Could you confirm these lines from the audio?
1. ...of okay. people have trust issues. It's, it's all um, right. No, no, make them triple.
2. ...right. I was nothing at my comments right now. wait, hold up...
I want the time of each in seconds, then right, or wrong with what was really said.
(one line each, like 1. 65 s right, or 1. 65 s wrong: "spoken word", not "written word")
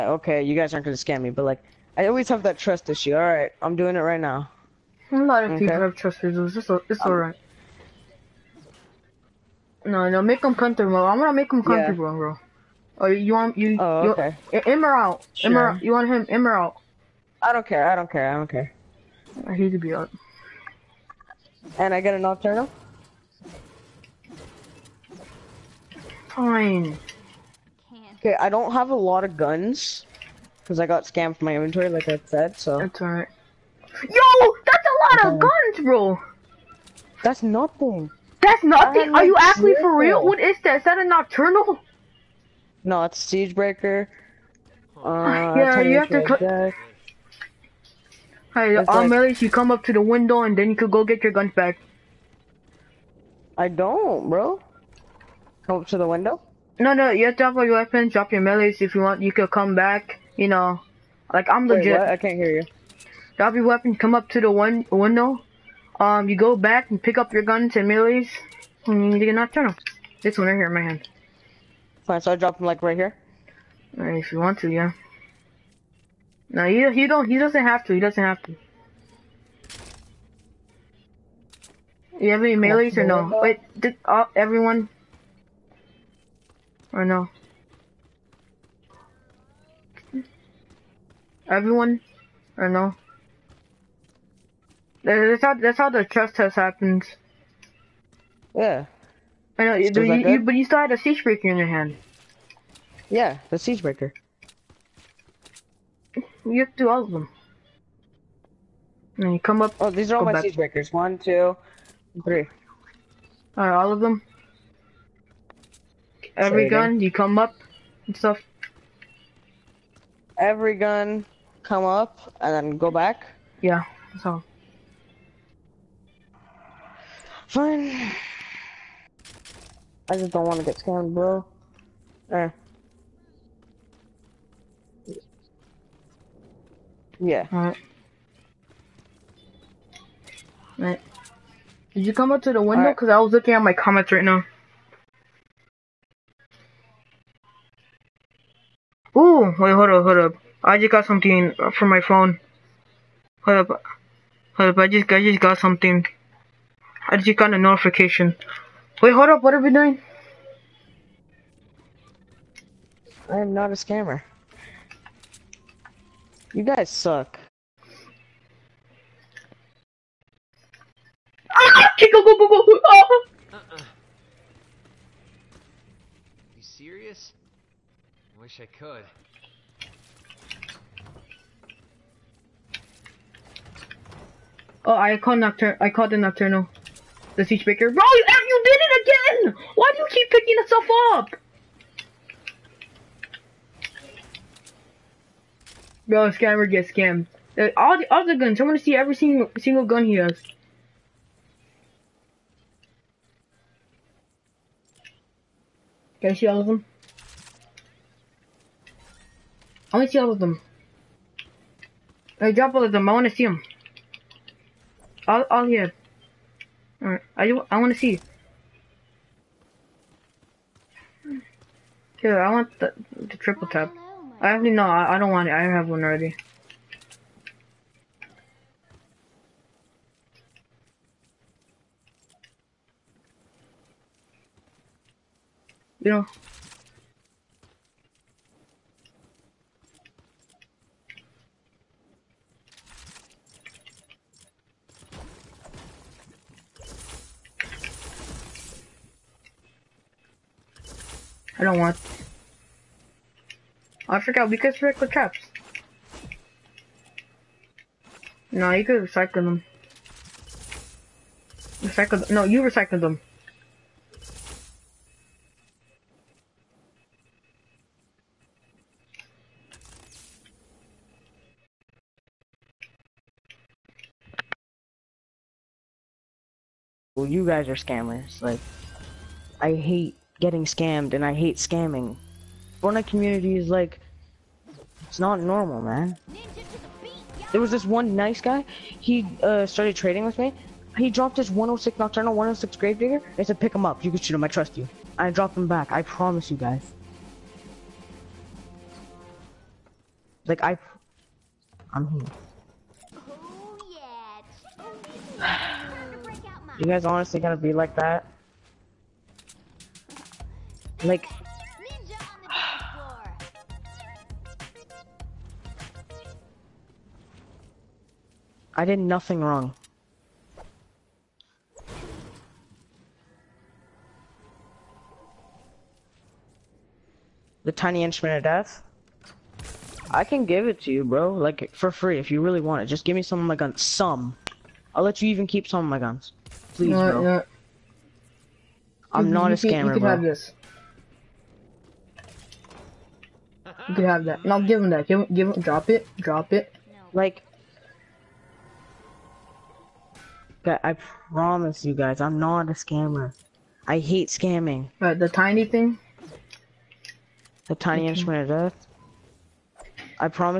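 1. 5 s wrong: "comfortable", not "triple"
2. 143 s wrong: "looking", not "nothing".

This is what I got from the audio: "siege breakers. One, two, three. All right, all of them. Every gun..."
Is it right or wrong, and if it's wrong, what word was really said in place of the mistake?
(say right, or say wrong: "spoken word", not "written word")
right.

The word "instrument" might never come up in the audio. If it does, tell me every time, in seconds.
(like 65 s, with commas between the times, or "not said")
328 s, 358 s.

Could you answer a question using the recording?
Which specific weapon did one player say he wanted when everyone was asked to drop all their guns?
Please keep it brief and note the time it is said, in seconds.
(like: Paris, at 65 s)
triple tap, at 223 s.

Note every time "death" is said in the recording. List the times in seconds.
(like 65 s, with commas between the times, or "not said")
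328 s, 358 s.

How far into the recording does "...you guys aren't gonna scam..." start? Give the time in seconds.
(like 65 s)
0 s.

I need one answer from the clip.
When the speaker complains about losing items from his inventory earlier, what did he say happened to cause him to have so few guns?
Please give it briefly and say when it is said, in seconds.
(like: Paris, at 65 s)
got scammed, at 30 s.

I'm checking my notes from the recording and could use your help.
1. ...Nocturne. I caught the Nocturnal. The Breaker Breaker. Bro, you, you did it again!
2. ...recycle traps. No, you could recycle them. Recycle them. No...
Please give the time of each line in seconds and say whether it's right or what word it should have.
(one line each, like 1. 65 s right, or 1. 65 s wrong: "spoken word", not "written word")
1. 185 s wrong: "Siege", not "Breaker"
2. 254 s right.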